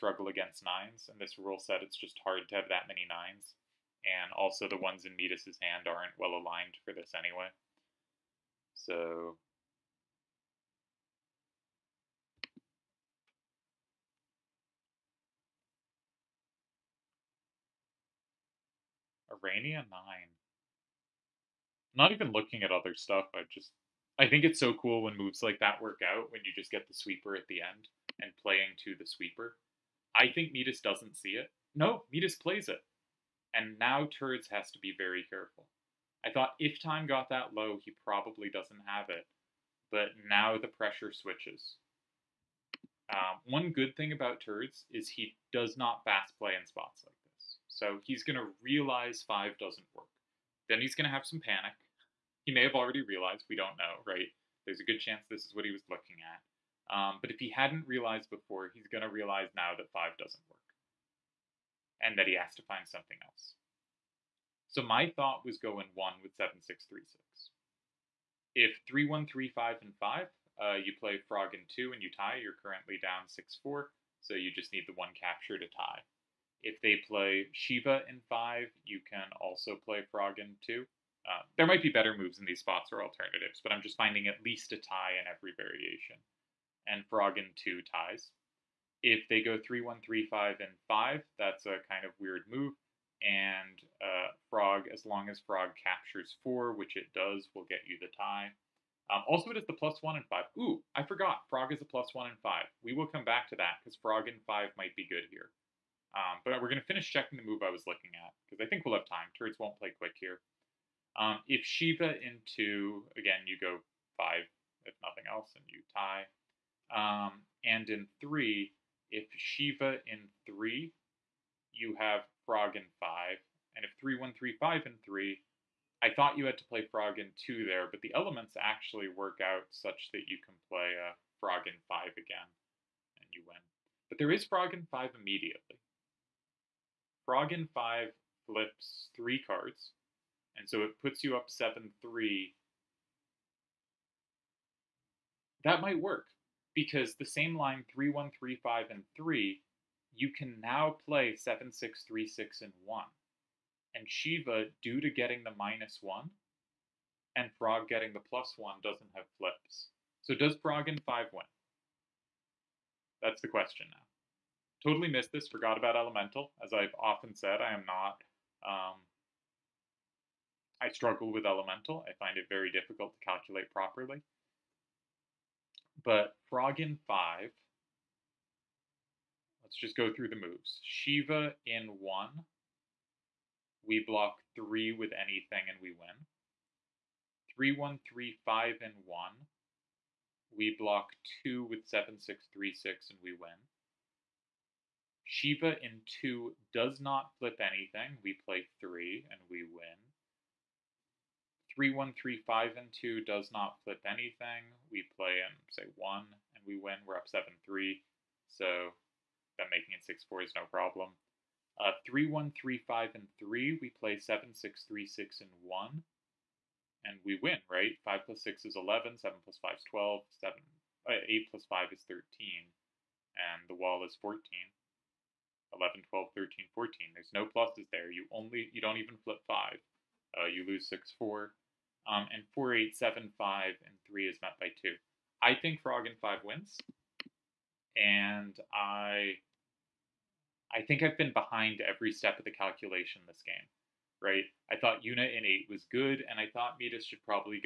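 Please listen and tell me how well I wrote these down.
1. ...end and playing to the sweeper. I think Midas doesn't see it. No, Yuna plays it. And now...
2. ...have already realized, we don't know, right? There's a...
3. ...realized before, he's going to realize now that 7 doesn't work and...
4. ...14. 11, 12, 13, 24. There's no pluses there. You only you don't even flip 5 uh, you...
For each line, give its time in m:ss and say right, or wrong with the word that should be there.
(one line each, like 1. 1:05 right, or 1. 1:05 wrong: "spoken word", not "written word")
1. 0:27 wrong: "Midas", not "Yuna"
2. 0:52 right
3. 0:57 wrong: "5", not "7"
4. 3:44 wrong: "14", not "24".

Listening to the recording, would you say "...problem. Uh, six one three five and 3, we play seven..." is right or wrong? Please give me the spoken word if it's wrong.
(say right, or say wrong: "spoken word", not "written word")
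wrong: "three", not "six".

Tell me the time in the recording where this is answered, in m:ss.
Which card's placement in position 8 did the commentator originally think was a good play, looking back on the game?
4:05.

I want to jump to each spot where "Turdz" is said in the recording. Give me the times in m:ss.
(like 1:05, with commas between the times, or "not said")
0:34, 0:44, 1:49.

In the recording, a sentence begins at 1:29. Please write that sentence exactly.
If they go 3, 1, 3, 5, and 5, that's a kind of weird move.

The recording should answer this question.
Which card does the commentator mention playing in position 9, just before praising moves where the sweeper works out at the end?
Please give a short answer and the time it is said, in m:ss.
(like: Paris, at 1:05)
Urania, at 0:19.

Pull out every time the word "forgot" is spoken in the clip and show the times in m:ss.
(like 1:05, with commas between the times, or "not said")
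1:41, 2:45.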